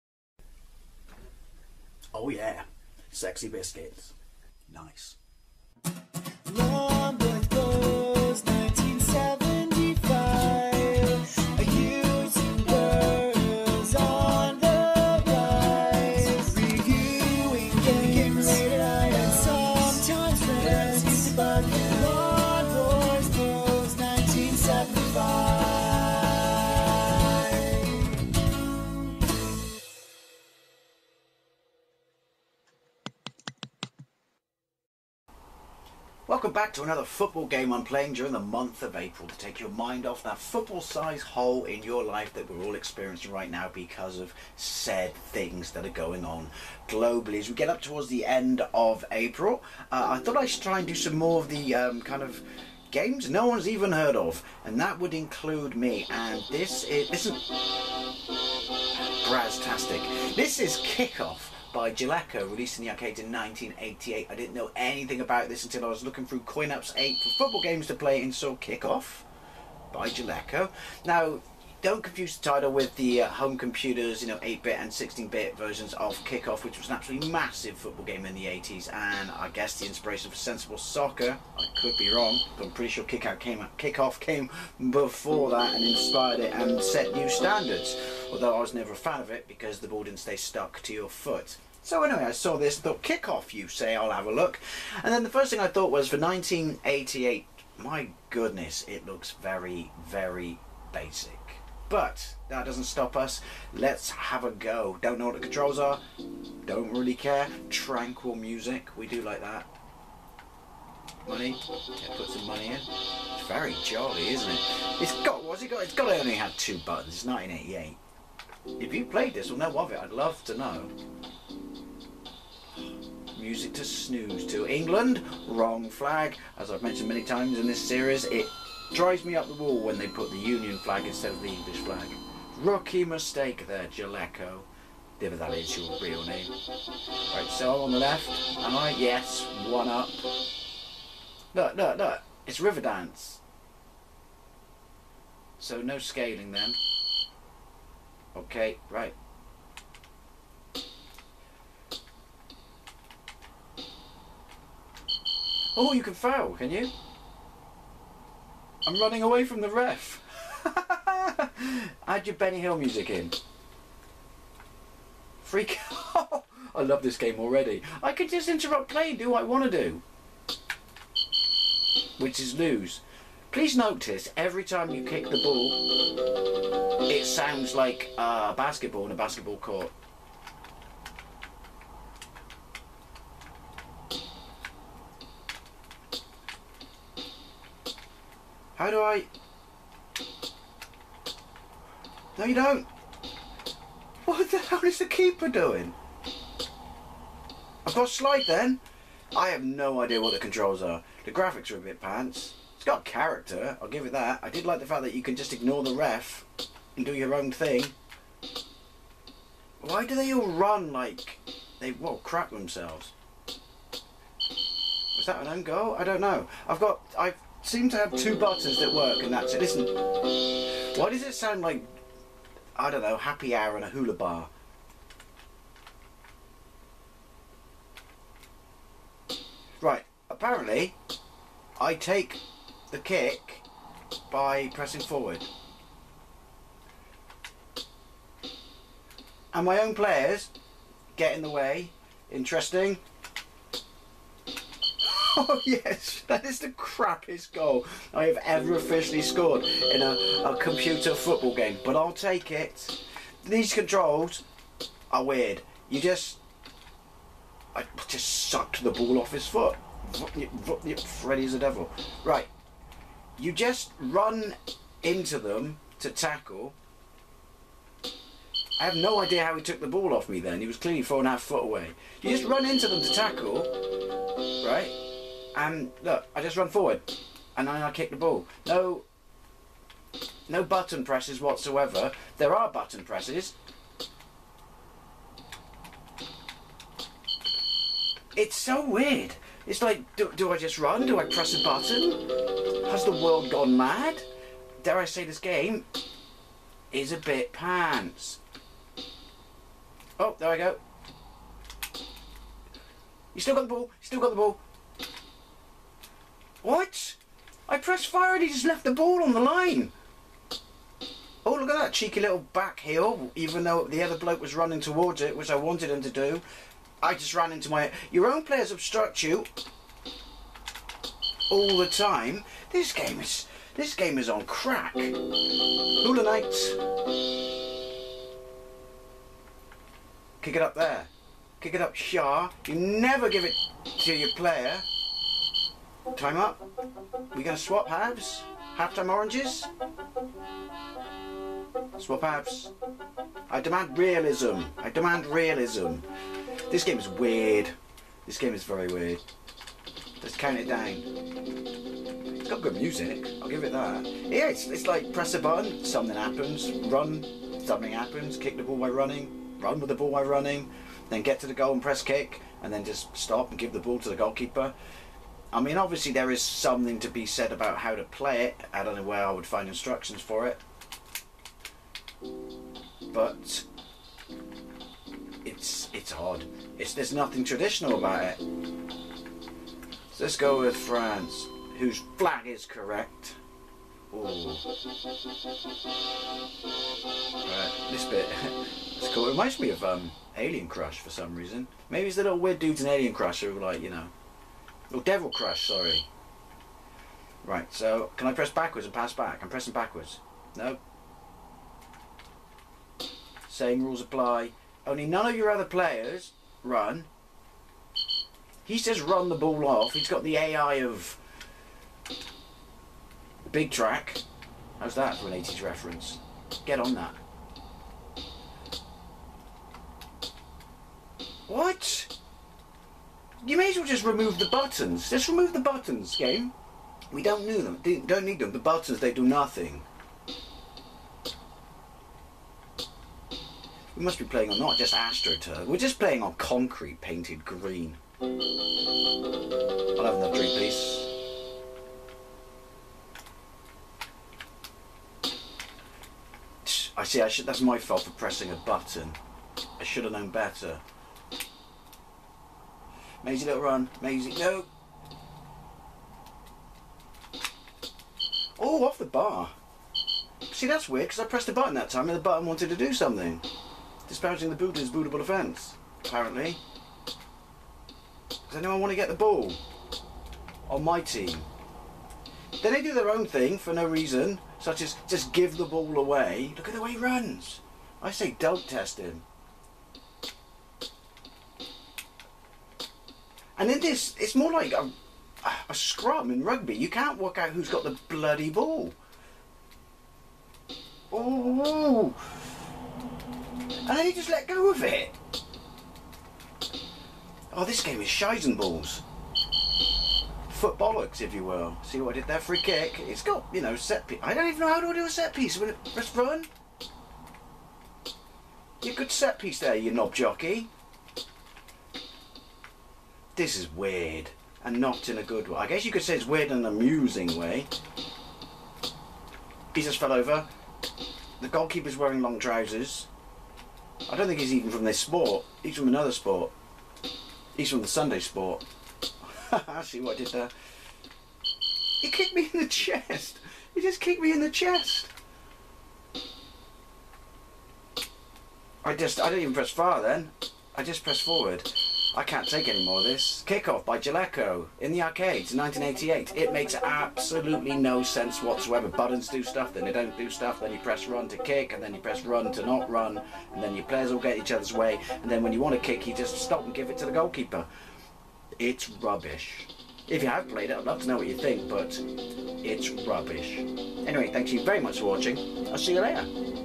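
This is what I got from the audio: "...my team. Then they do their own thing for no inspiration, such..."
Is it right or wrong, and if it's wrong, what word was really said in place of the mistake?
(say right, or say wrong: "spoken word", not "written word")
wrong: "reason", not "inspiration".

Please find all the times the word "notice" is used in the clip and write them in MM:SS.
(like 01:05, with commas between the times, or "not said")
02:53.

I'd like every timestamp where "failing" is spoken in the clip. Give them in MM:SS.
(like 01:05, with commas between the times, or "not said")
not said.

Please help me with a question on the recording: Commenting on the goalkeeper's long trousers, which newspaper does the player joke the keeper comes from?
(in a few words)
Sunday Sport.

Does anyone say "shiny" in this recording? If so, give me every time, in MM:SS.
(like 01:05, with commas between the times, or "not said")
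not said.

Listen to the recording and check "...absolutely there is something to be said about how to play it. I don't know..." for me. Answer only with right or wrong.
wrong.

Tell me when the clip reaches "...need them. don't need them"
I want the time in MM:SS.
07:07.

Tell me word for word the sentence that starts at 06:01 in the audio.
Then get to the goal and press kick.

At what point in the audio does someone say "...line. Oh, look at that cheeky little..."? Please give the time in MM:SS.
05:09.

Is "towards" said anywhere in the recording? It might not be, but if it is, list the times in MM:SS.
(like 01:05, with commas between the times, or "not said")
00:47, 05:14.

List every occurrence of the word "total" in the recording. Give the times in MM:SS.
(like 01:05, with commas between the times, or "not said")
not said.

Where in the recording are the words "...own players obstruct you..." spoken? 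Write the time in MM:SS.
05:18.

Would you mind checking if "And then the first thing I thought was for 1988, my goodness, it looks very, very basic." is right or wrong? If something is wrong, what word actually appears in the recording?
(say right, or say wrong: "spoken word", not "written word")
right.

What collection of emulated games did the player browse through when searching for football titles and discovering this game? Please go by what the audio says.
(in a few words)
CoinOPS 8.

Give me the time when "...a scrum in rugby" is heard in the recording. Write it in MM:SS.
08:05.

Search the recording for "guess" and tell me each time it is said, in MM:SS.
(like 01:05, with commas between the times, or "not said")
01:19, 08:35.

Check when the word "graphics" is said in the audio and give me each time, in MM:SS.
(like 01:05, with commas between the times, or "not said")
03:21.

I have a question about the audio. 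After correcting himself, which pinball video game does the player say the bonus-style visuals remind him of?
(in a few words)
Devil Crush.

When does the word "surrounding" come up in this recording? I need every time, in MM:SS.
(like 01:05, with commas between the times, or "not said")
not said.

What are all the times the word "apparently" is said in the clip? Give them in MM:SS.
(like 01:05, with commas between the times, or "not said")
03:50, 07:46.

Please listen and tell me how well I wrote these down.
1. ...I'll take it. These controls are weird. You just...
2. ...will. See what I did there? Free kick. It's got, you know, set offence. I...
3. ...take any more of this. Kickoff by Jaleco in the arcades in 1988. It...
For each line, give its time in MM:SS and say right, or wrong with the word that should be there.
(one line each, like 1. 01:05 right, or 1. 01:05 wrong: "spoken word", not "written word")
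1. 04:11 right
2. 08:21 wrong: "piece", not "offence"
3. 09:02 right.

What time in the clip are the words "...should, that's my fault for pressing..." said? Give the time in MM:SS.
07:27.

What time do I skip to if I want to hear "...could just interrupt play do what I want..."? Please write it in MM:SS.
02:48.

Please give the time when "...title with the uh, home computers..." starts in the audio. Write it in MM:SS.
01:12.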